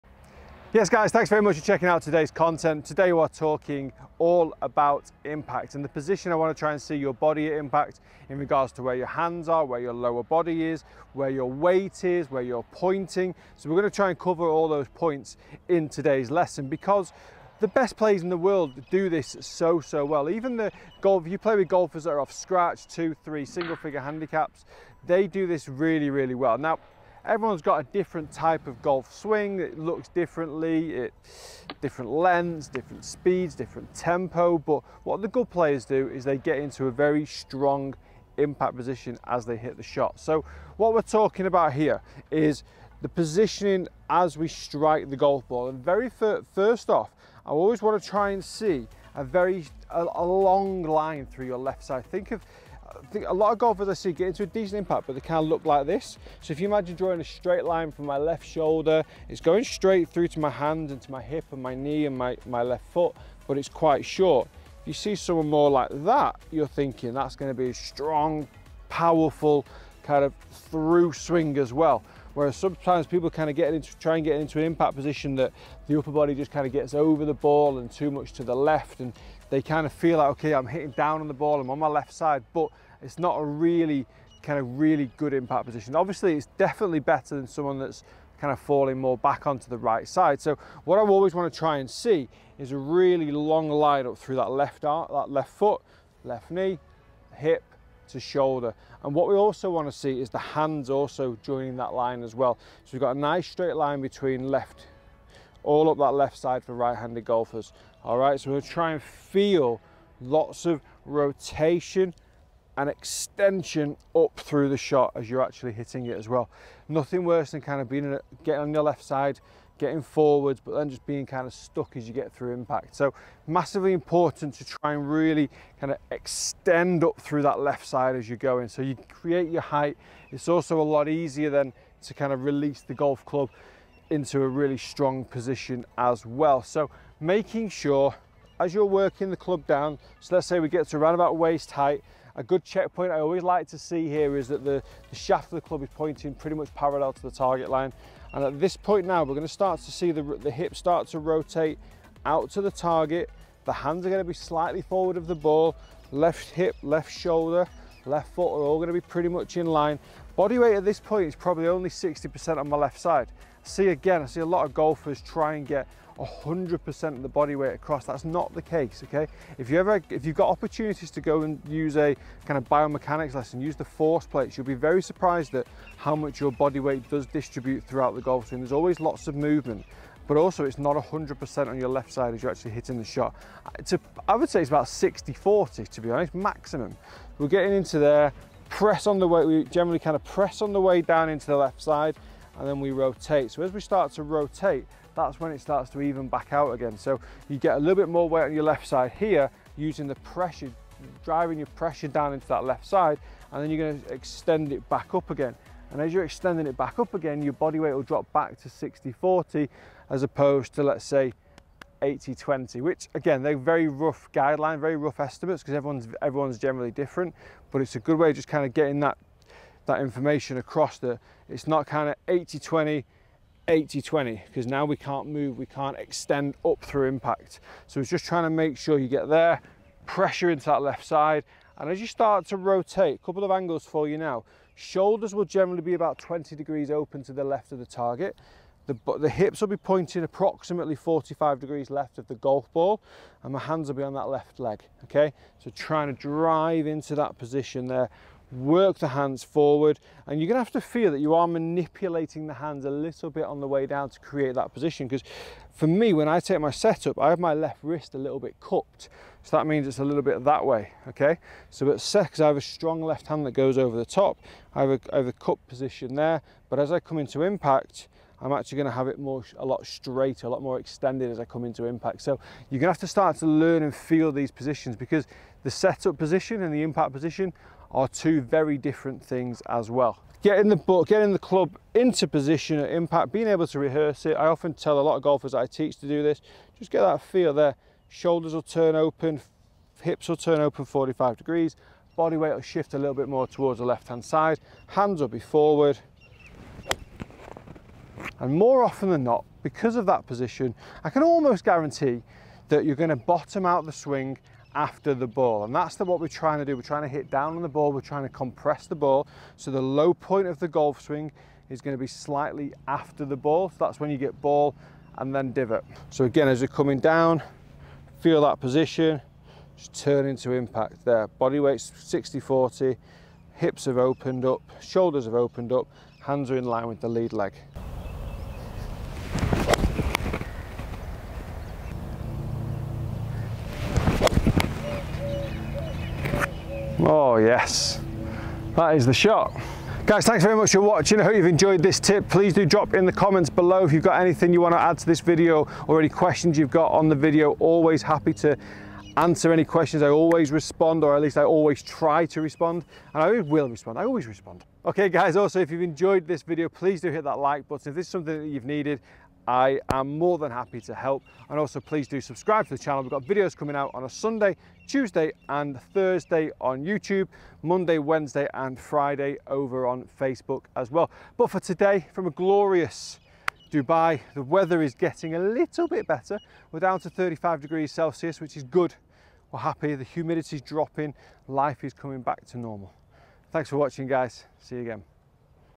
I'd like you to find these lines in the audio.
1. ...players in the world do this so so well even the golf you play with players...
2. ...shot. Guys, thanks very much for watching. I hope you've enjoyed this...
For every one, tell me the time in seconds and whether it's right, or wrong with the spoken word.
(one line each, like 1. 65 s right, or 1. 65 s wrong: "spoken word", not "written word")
1. 17 s wrong: "golfers", not "players"
2. 339 s right.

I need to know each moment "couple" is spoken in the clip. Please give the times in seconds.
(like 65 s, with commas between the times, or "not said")
233 s.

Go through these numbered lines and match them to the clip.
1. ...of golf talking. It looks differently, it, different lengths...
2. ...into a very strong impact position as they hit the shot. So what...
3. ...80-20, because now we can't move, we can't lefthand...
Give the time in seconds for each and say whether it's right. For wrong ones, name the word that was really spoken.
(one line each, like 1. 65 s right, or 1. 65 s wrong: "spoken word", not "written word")
1. 28 s wrong: "swing", not "talking"
2. 36 s right
3. 223 s wrong: "extend", not "lefthand".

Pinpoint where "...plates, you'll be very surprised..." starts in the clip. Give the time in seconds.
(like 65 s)
174 s.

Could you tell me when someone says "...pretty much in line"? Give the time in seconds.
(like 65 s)
159 s.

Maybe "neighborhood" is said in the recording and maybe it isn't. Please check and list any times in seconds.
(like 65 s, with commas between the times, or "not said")
not said.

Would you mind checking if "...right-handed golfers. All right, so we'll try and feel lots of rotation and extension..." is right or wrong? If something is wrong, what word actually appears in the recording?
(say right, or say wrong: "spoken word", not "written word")
right.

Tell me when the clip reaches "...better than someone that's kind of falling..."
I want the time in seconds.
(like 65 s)
86 s.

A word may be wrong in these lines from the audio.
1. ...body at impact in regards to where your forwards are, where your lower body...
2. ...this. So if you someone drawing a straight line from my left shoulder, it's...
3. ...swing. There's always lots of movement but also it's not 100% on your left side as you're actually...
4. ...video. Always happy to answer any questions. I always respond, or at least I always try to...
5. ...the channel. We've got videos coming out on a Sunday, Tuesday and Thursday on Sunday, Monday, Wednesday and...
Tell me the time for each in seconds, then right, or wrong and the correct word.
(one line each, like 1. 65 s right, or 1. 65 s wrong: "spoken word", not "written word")
1. 7 s wrong: "hands", not "forwards"
2. 55 s wrong: "imagine", not "someone"
3. 178 s right
4. 347 s right
5. 362 s wrong: "YouTube", not "Sunday".